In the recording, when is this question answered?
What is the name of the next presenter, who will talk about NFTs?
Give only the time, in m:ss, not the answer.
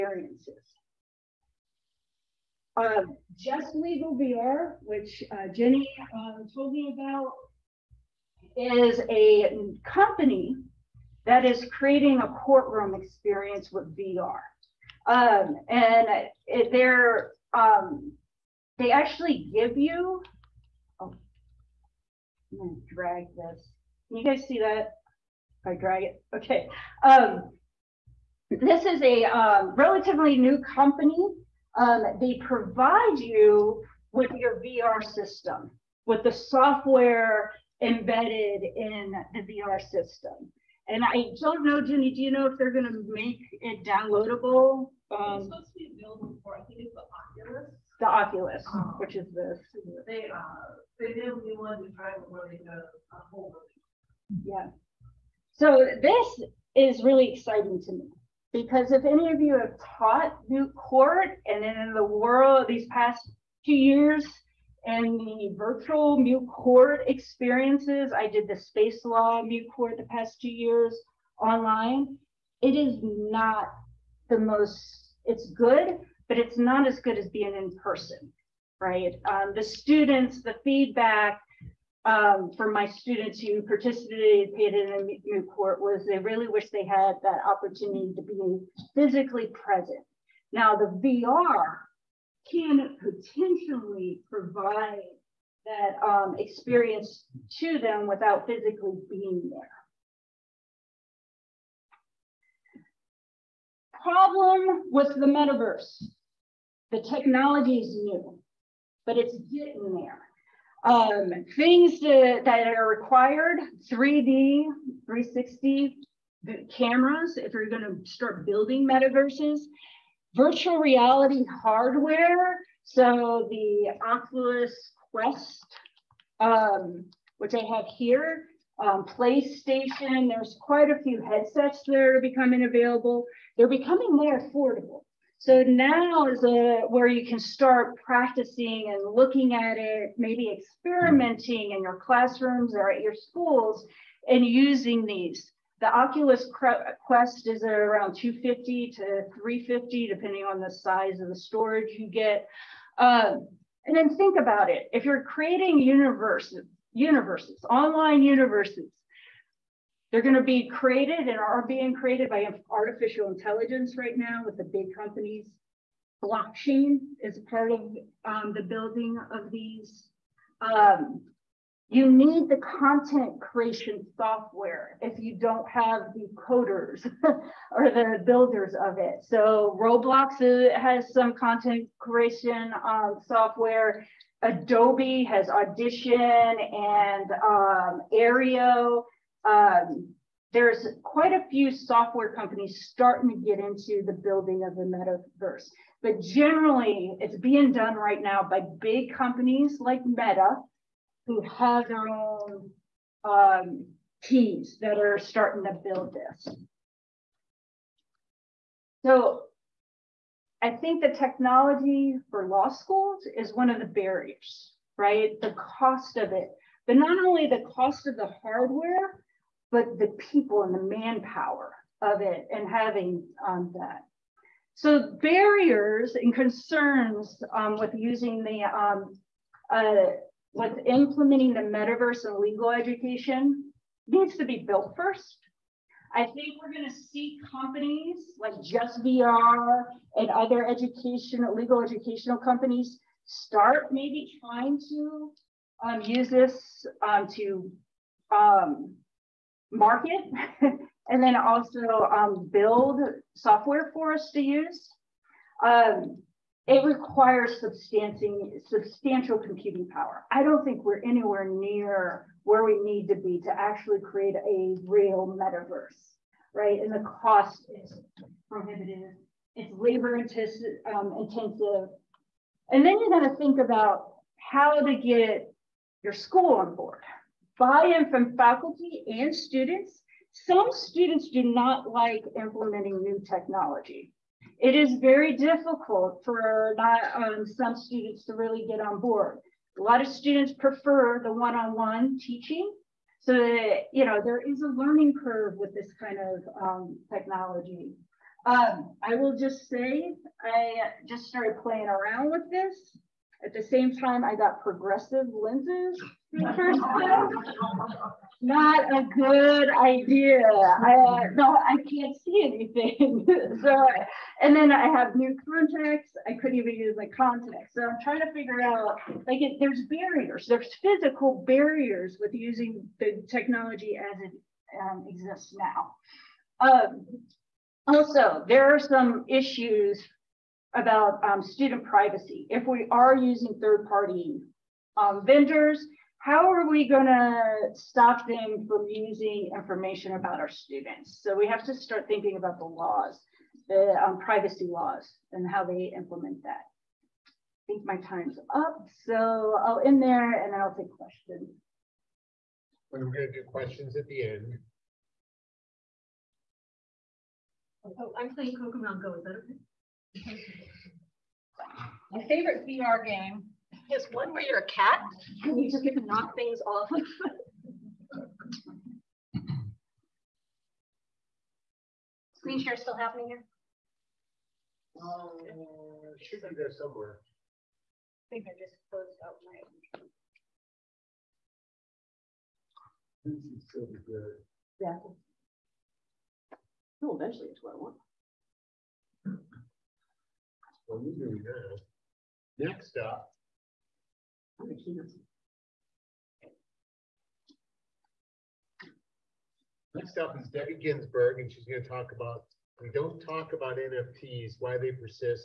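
6:40.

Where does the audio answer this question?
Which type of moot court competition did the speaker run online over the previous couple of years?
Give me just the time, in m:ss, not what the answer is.
1:08.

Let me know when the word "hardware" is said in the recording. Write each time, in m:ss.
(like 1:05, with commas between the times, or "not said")
2:01, 3:38.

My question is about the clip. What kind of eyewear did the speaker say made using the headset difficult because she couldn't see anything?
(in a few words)
progressive lenses.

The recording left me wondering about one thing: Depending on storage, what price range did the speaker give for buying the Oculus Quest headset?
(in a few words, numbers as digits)
250 to 350.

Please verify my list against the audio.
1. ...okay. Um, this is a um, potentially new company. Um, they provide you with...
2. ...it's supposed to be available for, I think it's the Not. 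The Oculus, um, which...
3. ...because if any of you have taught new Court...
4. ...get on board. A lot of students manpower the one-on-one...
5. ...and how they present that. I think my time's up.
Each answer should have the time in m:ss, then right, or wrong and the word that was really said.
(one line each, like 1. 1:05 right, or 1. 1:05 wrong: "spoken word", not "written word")
1. 0:26 wrong: "relatively", not "potentially"
2. 0:45 wrong: "Oculus", not "Not"
3. 0:58 right
4. 4:48 wrong: "prefer", not "manpower"
5. 5:45 wrong: "implement", not "present".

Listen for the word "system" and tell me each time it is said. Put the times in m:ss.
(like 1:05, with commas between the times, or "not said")
0:35, 0:39.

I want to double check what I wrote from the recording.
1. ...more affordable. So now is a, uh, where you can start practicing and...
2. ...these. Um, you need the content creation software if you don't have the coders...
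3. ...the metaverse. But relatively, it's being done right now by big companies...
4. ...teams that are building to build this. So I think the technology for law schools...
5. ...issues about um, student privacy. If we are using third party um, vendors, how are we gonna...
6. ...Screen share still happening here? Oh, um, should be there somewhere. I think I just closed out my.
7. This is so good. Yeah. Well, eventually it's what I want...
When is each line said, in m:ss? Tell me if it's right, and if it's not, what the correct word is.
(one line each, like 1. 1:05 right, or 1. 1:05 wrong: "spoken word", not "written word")
1. 2:14 right
2. 2:49 right
3. 3:14 wrong: "generally", not "relatively"
4. 3:24 wrong: "starting", not "building"
5. 5:29 right
6. 6:12 right
7. 6:23 right.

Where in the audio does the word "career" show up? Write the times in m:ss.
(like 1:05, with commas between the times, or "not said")
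not said.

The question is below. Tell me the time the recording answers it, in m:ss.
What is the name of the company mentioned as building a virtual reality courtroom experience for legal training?
0:03.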